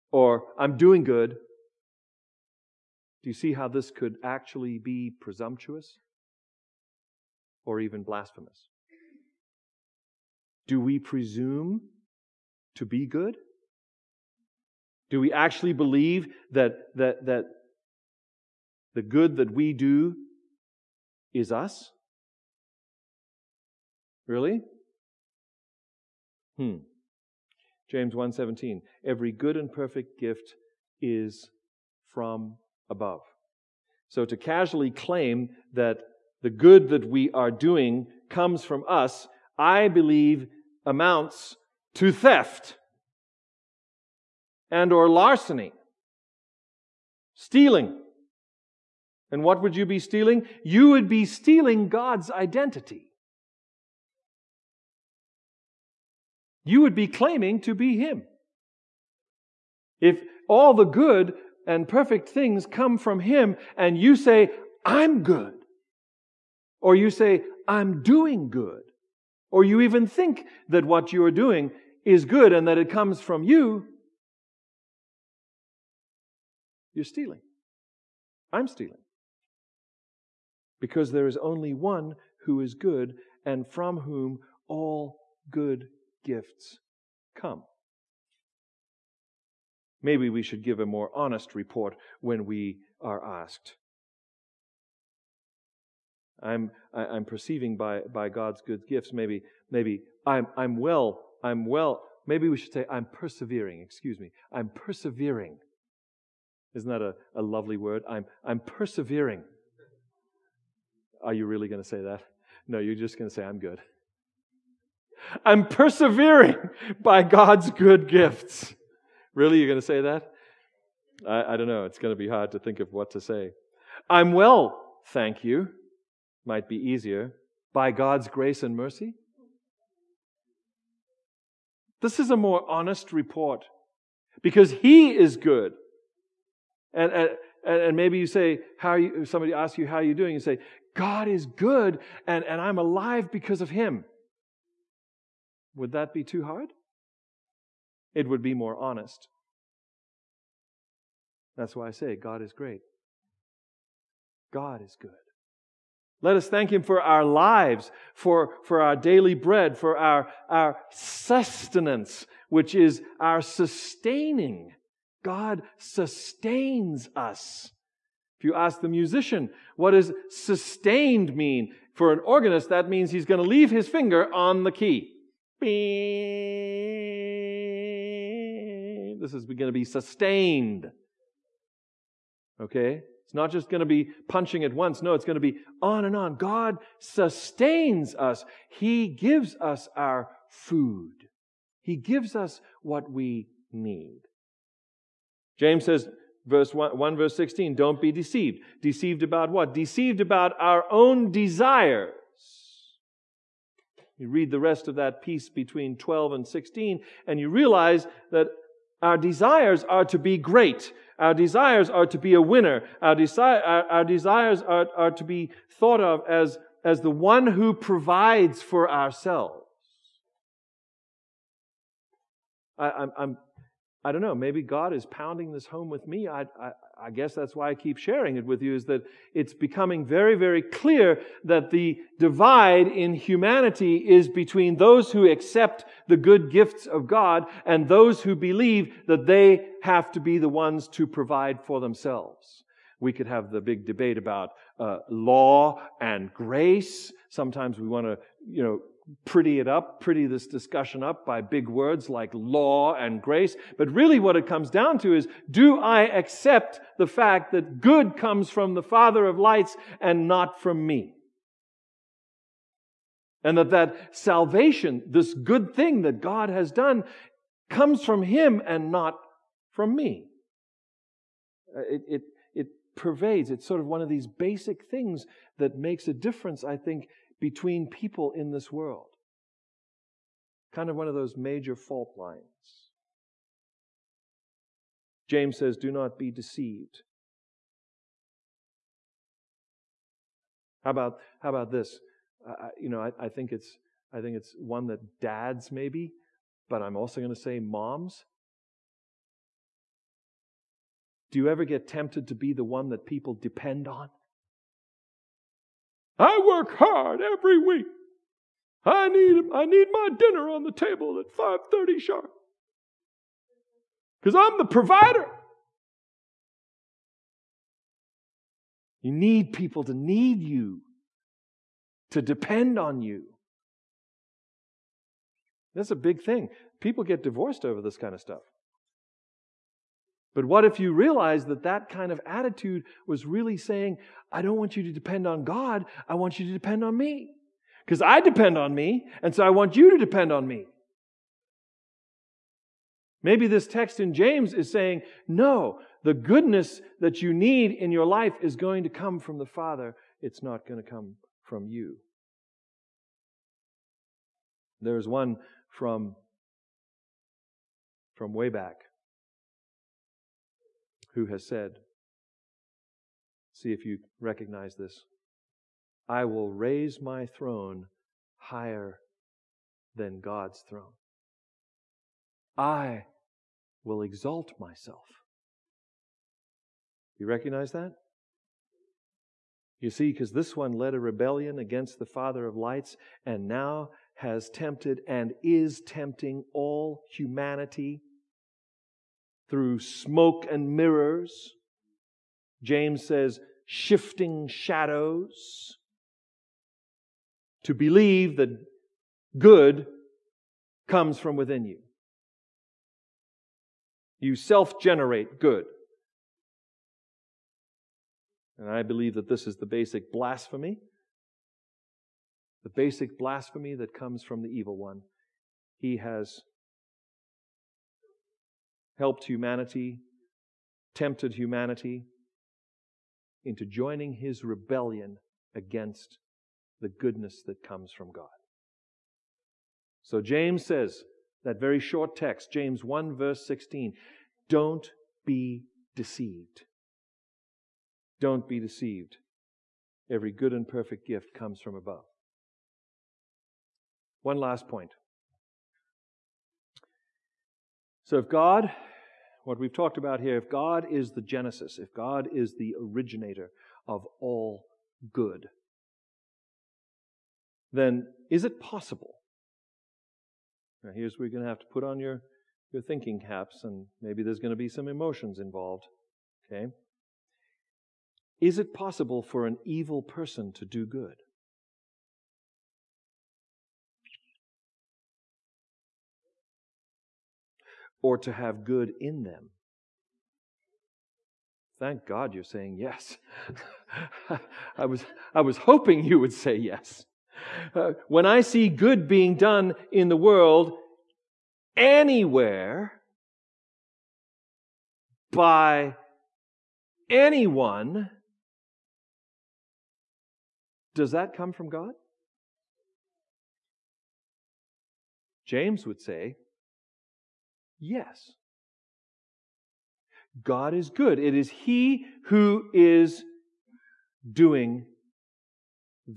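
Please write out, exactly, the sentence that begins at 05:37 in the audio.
Because I depend on me, and so I want you to depend on me.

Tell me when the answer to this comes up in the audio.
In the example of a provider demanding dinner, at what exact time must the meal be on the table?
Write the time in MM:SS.
05:11.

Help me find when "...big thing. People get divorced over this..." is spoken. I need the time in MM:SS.
05:25.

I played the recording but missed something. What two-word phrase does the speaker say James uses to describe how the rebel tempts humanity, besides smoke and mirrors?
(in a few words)
shifting shadows.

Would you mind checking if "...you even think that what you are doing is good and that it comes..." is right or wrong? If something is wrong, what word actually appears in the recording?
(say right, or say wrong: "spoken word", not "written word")
right.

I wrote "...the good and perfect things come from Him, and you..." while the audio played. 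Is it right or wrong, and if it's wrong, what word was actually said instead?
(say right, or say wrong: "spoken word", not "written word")
right.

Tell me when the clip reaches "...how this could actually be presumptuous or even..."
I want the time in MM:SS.
00:03.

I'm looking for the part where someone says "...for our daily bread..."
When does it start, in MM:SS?
02:38.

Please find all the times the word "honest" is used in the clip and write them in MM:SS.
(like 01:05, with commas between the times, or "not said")
01:31, 02:12, 02:28.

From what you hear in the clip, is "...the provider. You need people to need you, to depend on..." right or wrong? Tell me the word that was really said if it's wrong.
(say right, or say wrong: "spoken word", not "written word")
right.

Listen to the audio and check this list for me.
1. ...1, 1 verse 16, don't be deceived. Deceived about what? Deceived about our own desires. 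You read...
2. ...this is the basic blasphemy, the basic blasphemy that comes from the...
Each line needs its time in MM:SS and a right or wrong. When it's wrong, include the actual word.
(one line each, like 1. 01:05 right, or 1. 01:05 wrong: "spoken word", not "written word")
1. 03:16 right
2. 06:49 right.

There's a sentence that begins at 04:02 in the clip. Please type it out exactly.
We could have the big debate about uh, law and grace.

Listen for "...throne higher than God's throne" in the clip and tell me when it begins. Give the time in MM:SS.
06:07.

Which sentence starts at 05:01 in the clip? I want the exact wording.
Do you ever get tempted to be the one that people depend on?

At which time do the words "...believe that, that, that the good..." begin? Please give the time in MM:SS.
00:15.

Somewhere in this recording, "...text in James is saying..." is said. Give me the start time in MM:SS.
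05:43.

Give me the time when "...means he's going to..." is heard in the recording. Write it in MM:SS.
02:52.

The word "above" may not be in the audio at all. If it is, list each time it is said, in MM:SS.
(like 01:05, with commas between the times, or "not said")
00:32, 07:21.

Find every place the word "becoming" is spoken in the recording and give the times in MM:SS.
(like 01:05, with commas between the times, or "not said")
03:49.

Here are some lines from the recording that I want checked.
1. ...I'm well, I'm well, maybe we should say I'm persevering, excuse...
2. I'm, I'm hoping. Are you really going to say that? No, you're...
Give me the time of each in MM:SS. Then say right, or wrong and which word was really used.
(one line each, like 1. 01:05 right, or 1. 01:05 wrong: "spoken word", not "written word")
1. 01:40 right
2. 01:48 wrong: "persevering", not "hoping".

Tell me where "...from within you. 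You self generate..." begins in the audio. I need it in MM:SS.
06:41.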